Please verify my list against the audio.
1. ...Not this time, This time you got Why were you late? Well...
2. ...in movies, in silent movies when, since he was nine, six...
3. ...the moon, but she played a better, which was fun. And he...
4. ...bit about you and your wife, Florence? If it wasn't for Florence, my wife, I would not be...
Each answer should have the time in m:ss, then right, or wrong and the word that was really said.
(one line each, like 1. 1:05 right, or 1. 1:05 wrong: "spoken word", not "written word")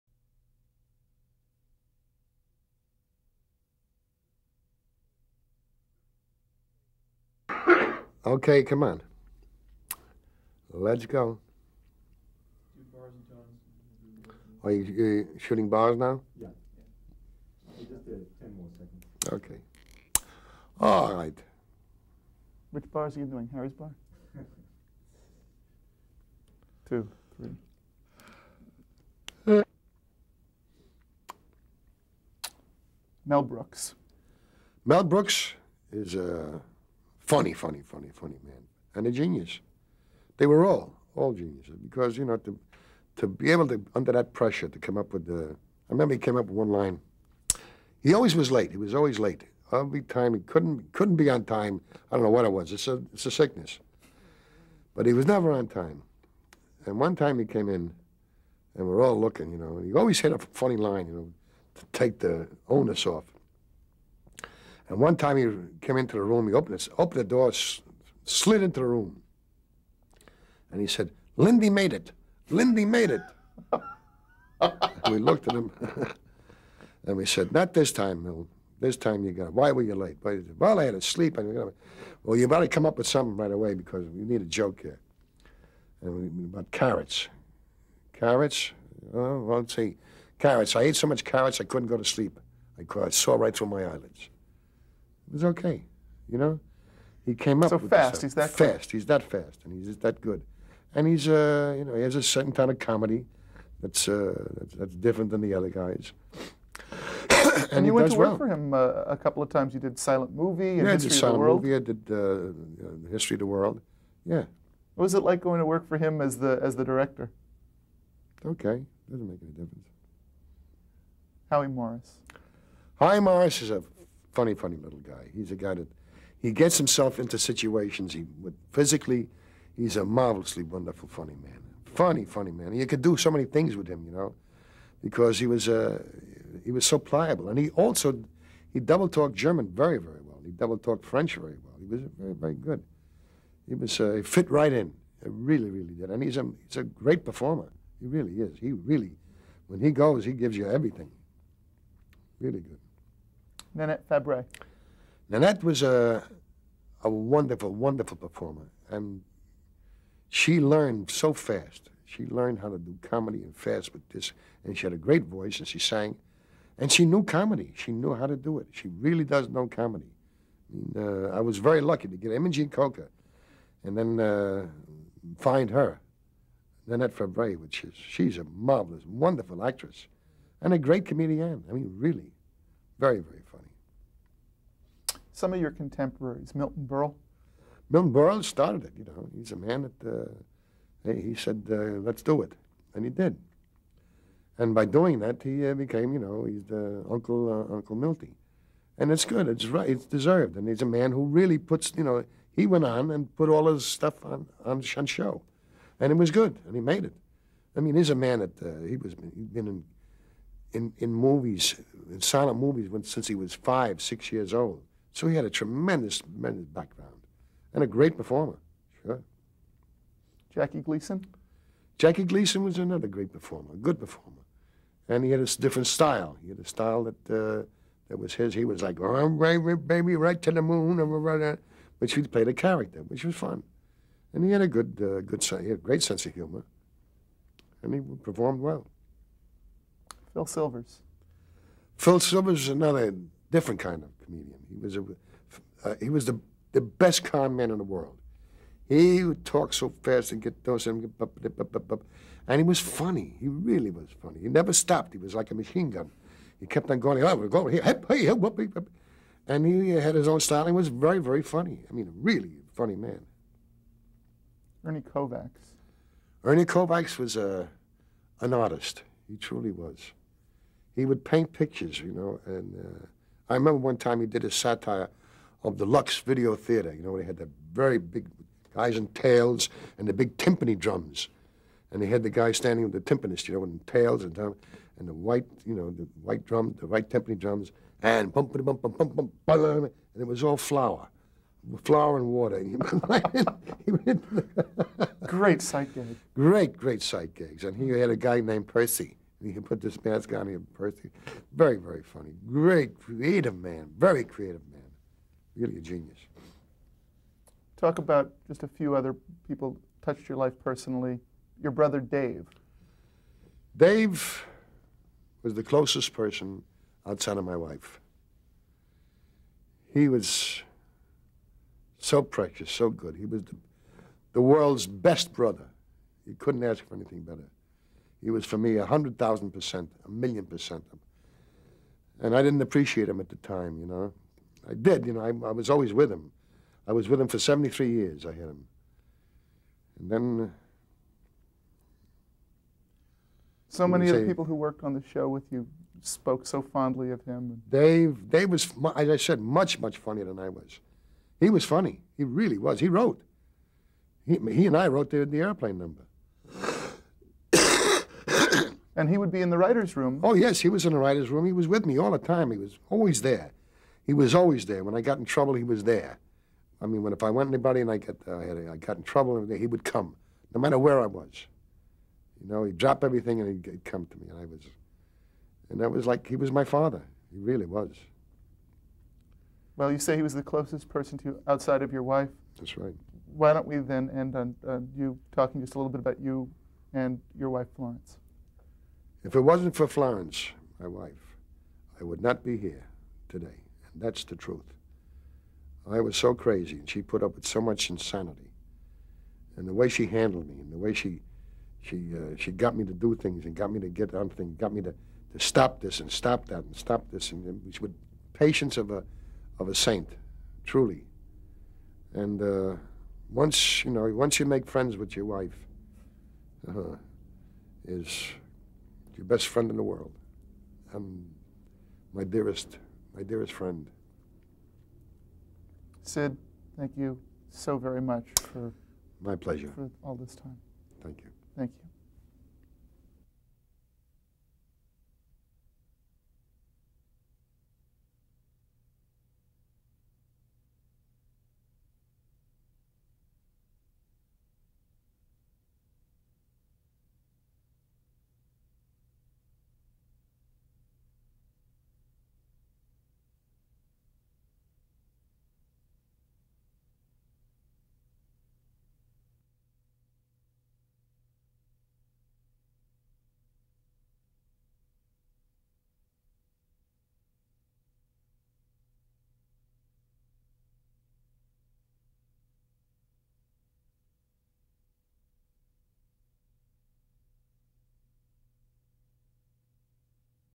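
1. 1:17 right
2. 3:30 wrong: "five", not "nine"
3. 3:50 wrong: "character", not "better"
4. 6:25 right.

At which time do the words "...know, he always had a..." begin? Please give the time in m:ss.
0:59.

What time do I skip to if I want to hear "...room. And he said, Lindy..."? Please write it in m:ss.
1:08.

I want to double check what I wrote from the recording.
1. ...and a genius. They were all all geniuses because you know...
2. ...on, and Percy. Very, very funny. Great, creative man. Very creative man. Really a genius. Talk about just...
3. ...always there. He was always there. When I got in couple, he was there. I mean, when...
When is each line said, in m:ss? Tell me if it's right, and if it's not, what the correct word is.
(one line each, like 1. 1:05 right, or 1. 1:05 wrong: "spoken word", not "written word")
1. 0:38 right
2. 5:00 right
3. 6:02 wrong: "trouble", not "couple".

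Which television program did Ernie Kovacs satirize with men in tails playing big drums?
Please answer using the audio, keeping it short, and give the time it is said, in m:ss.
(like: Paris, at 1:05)
Lux Video Theater, at 4:35.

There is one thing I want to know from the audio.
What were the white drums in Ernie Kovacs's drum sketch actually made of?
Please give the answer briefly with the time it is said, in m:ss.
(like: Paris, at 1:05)
flour and water, at 4:50.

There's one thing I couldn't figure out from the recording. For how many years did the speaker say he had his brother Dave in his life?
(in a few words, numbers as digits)
73.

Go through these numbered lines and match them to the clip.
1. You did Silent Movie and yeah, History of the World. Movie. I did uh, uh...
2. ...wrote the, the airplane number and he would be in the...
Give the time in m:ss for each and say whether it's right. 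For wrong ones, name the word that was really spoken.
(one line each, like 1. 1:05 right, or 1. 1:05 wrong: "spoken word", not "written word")
1. 1:49 right
2. 5:54 right.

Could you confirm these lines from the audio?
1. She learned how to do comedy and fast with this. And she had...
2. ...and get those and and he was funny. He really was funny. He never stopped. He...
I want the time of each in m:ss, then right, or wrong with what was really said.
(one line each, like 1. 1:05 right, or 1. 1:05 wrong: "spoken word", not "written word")
1. 2:42 right
2. 4:10 right.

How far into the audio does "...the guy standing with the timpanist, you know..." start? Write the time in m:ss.
4:42.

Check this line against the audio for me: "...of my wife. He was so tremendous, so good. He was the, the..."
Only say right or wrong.
wrong.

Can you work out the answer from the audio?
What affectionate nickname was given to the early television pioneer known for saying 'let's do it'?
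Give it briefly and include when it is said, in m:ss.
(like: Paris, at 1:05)
Uncle Milty, at 3:17.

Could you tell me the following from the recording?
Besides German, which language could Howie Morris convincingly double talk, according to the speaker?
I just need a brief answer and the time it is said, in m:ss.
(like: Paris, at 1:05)
French, at 2:20.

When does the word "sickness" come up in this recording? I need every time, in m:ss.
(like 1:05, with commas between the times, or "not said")
0:53.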